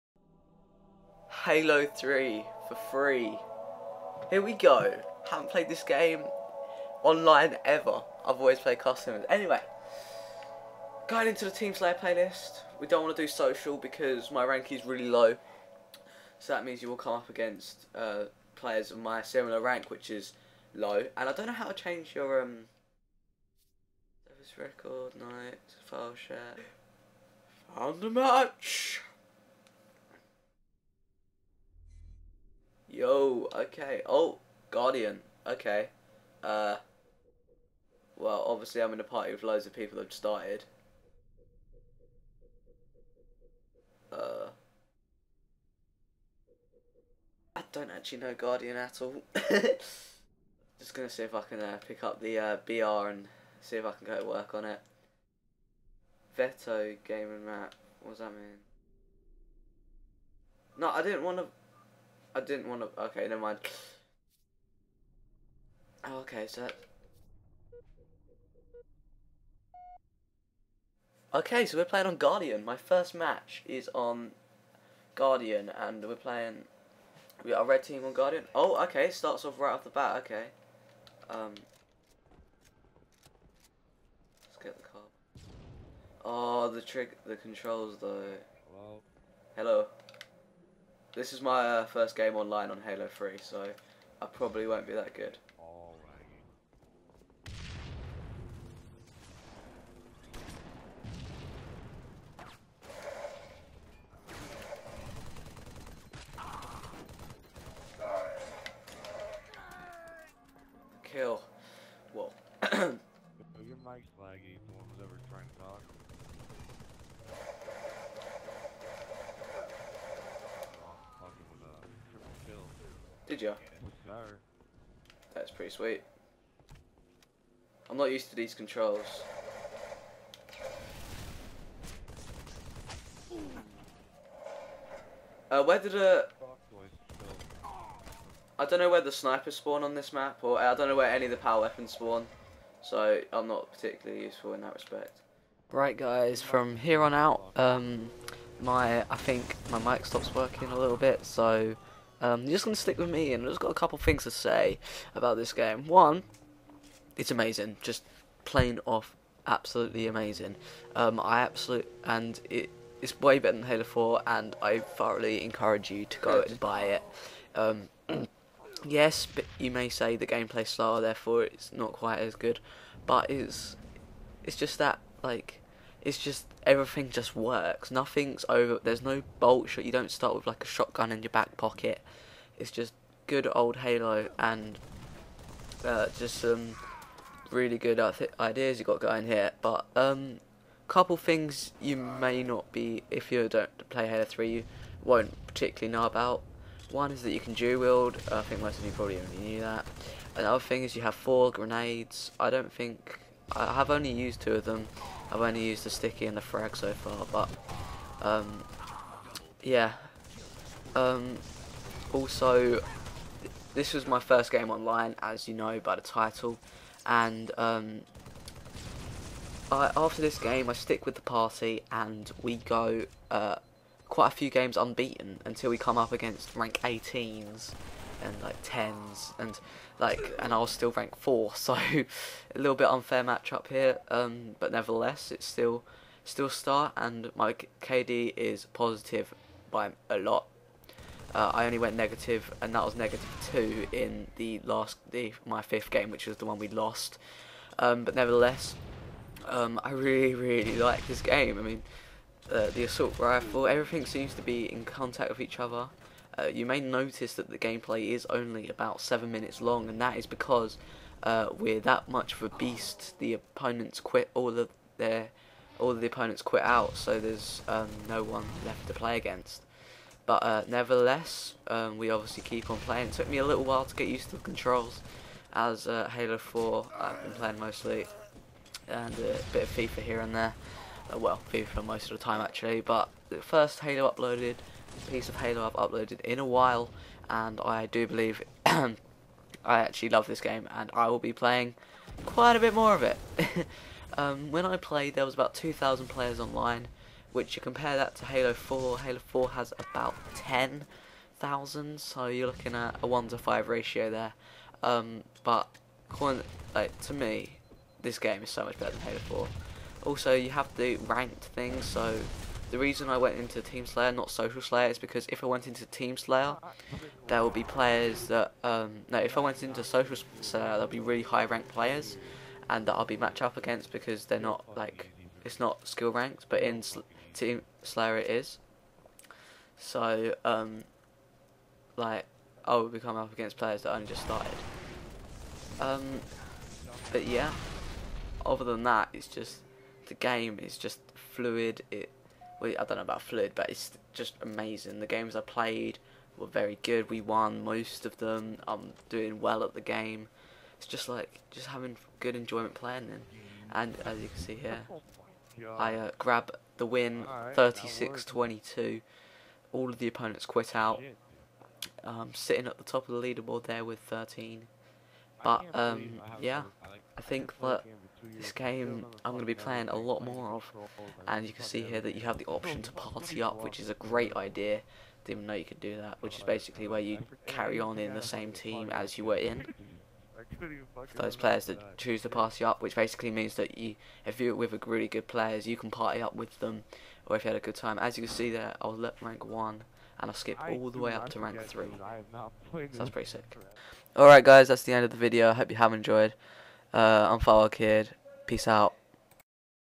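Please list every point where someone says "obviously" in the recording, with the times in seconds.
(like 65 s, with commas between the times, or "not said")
38 s, 272 s.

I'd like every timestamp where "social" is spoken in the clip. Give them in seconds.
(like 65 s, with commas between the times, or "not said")
13 s, 314 s, 319 s.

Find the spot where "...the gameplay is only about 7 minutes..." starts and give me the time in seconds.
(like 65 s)
257 s.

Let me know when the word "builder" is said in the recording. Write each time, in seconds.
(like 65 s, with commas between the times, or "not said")
not said.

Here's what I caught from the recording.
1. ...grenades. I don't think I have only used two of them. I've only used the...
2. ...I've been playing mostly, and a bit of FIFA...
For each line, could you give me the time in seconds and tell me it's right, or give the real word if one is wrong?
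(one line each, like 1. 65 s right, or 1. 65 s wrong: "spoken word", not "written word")
1. 201 s right
2. 276 s right.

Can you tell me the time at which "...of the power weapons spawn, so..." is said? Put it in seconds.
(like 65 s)
141 s.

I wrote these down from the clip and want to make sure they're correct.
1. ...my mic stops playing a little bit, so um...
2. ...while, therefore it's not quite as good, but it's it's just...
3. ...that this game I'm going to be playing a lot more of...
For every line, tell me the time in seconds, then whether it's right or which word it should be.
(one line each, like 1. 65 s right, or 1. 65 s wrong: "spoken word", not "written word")
1. 149 s wrong: "working", not "playing"
2. 170 s wrong: "style", not "while"
3. 367 s right.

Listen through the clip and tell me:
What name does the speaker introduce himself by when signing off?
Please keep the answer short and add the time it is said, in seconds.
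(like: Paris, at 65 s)
Follow Kid, at 397 s.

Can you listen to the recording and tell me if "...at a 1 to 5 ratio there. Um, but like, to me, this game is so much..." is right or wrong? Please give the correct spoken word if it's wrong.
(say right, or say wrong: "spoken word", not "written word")
right.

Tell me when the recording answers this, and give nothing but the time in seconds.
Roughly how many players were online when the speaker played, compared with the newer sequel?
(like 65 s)
295 s.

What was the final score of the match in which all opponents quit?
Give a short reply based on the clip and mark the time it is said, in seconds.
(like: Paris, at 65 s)
36-22, at 357 s.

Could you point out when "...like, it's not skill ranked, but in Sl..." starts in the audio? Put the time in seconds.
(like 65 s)
324 s.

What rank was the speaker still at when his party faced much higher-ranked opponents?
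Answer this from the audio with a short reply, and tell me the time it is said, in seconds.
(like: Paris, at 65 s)
4, at 230 s.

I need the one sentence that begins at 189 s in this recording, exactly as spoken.
But um, couple things you may not be if you don't play Halo 3, you won't particularly know about.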